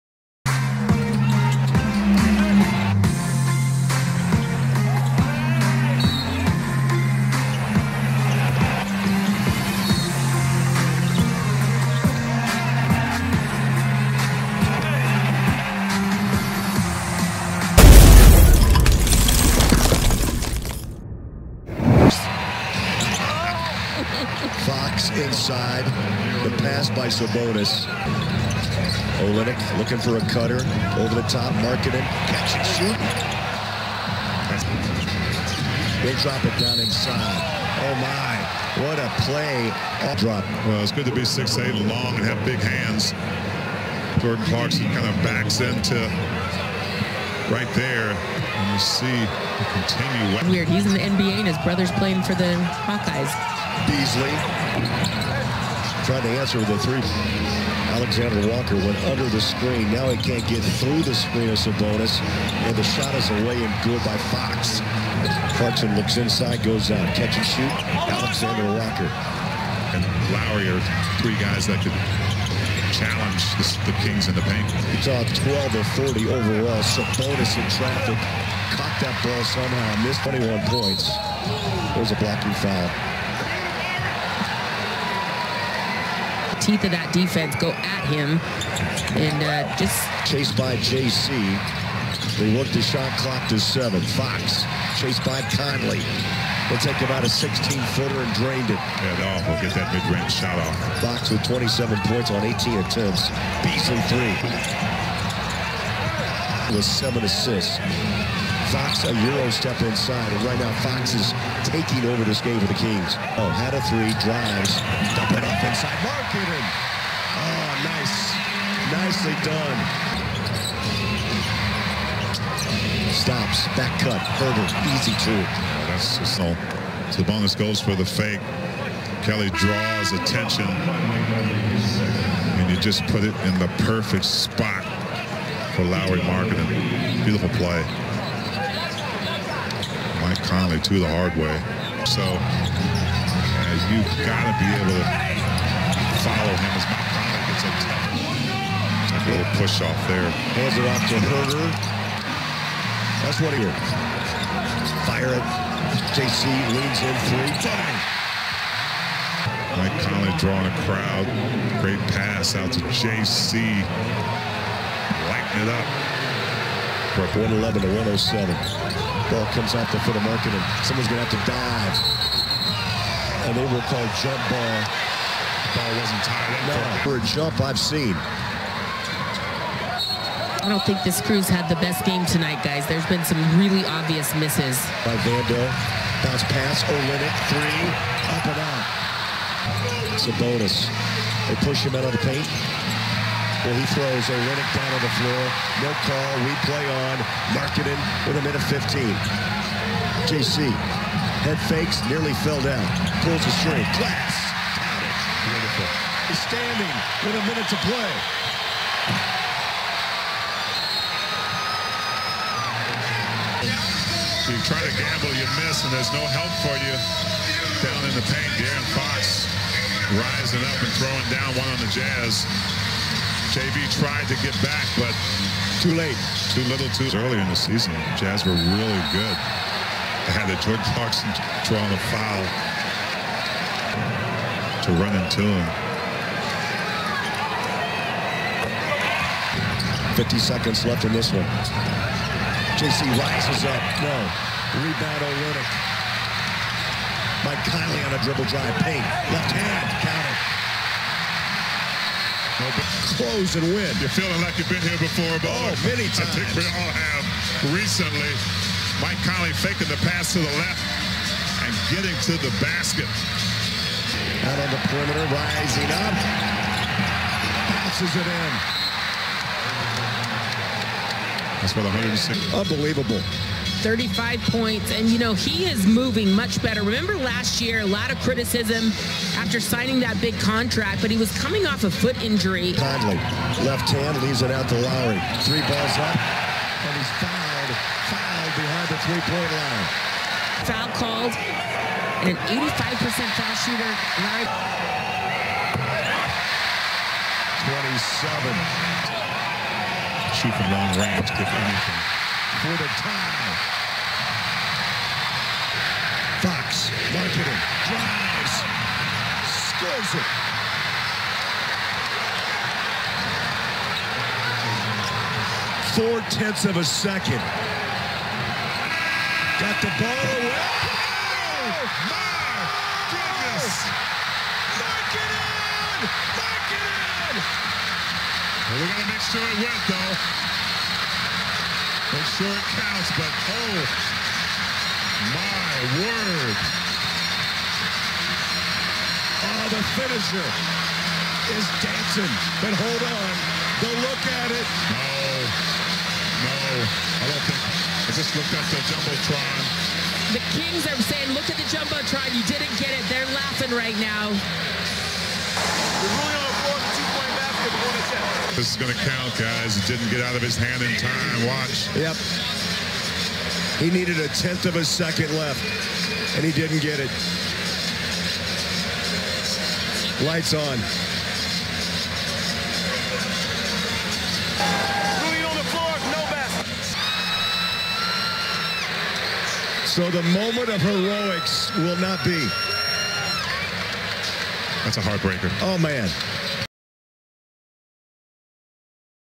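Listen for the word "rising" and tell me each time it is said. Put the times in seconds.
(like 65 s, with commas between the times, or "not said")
220 s, 265 s.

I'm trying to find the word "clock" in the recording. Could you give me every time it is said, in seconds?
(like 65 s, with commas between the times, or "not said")
93 s.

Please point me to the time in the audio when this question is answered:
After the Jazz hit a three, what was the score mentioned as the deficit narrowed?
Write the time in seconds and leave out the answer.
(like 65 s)
167 s.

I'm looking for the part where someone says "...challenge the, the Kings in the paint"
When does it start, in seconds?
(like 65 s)
72 s.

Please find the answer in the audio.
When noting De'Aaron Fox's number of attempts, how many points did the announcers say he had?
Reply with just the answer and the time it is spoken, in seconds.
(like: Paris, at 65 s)
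27, at 101 s.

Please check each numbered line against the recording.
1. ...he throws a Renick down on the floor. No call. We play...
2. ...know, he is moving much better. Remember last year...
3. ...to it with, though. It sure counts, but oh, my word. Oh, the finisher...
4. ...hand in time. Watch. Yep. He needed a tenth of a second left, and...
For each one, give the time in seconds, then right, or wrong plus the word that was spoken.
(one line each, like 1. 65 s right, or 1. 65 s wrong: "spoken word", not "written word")
1. 193 s right
2. 275 s right
3. 329 s right
4. 360 s right.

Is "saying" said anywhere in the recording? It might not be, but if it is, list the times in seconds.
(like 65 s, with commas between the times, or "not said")
351 s.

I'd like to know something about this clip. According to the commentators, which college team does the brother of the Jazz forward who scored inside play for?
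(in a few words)
Hawkeyes.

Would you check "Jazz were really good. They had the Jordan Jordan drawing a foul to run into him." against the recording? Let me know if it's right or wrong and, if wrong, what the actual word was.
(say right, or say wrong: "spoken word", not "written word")
wrong: "Clarkson", not "Jordan".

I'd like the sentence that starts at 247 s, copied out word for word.
Mike Conley on a dribble drive.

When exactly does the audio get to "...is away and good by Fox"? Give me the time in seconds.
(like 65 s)
63 s.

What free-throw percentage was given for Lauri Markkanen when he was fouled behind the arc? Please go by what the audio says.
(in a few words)
85%.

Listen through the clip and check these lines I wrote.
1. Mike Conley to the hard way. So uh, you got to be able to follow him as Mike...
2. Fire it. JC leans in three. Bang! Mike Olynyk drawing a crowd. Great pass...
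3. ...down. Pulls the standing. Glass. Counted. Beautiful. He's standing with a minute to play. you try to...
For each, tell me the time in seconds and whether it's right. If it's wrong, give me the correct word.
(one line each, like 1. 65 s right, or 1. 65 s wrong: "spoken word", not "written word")
1. 140 s right
2. 155 s wrong: "Conley", not "Olynyk"
3. 202 s wrong: "string", not "standing".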